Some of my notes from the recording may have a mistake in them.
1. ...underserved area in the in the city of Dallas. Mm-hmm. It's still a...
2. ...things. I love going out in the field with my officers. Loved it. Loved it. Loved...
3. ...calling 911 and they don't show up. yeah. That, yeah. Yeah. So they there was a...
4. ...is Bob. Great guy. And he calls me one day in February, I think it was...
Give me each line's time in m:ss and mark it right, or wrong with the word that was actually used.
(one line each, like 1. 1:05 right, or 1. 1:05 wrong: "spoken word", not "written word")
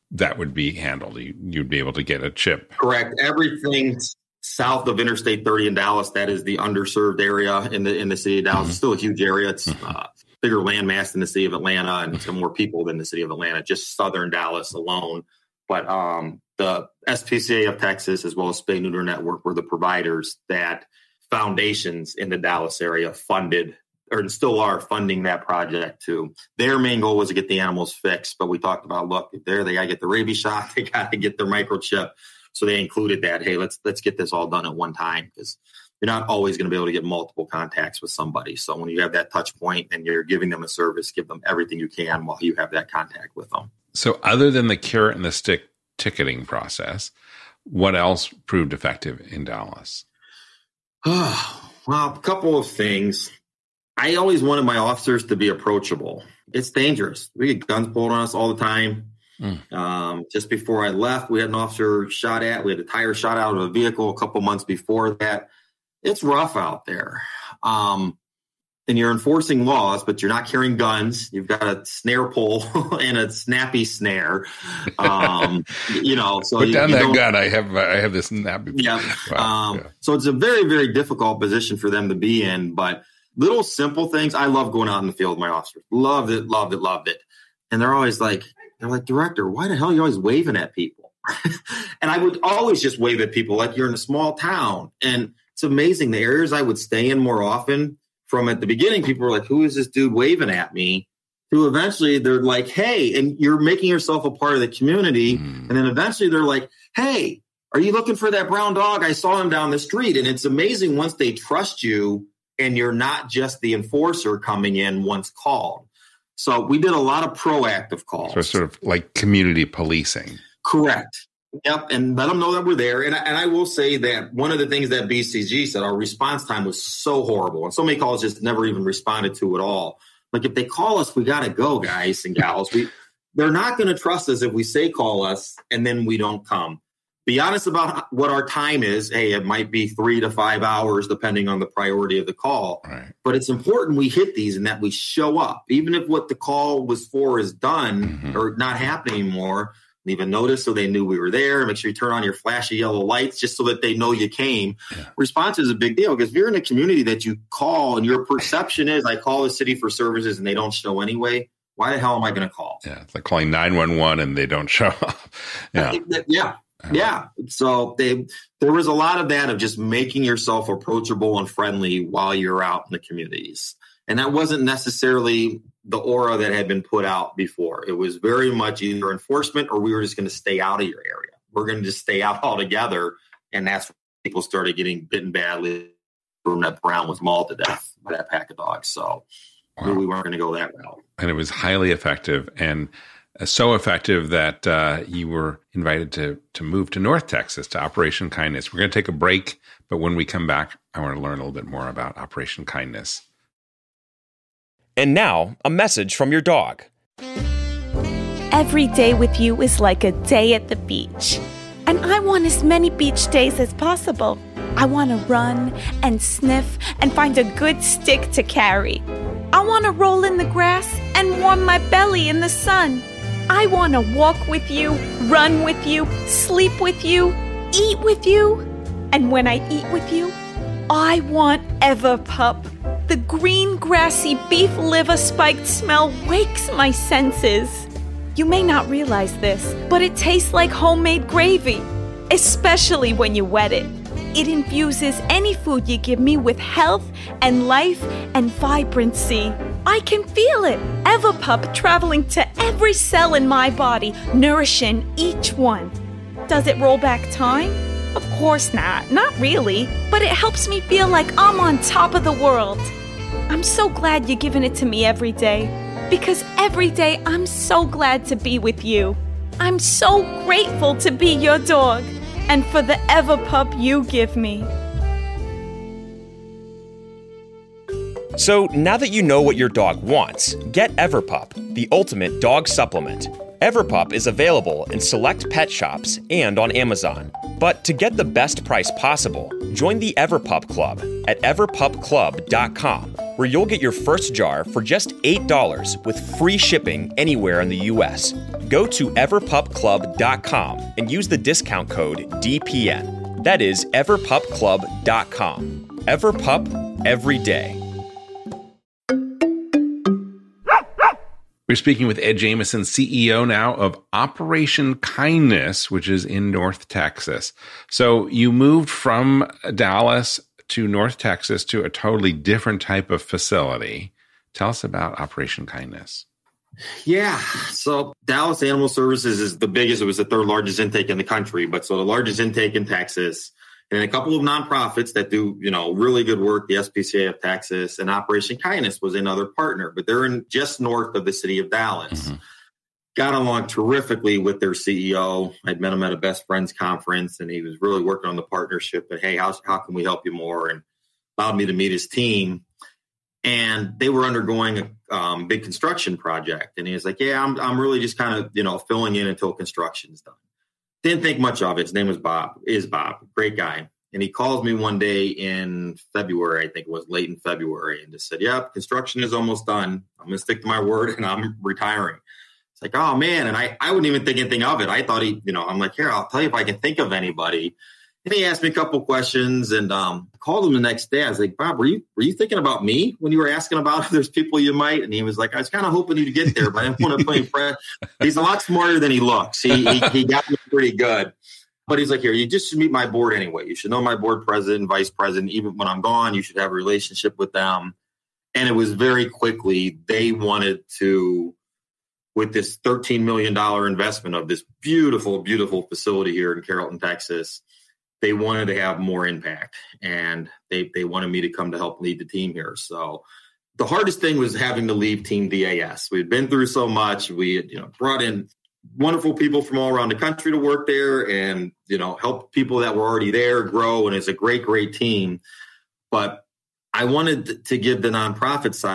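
1. 0:06 right
2. 1:24 right
3. 2:43 right
4. 6:02 right.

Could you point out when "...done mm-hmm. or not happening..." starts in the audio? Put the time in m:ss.
2:27.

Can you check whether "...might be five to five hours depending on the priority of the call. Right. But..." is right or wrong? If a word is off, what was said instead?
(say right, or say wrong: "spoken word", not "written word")
wrong: "three", not "five".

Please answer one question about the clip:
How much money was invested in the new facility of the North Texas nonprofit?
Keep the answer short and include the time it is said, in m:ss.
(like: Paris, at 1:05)
$13 million, at 6:42.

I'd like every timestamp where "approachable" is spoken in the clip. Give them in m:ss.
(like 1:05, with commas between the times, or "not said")
0:55, 2:50.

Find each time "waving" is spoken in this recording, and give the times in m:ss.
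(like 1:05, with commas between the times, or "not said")
1:30, 1:40.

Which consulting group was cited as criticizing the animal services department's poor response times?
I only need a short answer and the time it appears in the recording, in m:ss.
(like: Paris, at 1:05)
BCG, at 2:05.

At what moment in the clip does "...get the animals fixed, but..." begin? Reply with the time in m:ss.
0:27.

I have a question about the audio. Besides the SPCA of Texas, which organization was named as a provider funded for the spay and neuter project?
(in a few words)
Spay Neuter Network.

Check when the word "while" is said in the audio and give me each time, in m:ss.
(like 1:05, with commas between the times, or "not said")
0:42, 2:52.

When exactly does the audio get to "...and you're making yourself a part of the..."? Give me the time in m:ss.
1:43.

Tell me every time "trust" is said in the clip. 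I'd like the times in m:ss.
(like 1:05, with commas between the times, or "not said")
1:51, 2:13.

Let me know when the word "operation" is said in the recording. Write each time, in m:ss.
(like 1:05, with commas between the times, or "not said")
3:17, 3:22, 5:14, 5:25, 5:38.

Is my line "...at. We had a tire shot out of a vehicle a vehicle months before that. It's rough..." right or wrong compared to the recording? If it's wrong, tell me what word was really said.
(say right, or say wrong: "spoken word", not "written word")
wrong: "couple", not "vehicle".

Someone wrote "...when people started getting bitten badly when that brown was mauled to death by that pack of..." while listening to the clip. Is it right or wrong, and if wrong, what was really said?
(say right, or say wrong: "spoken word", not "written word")
right.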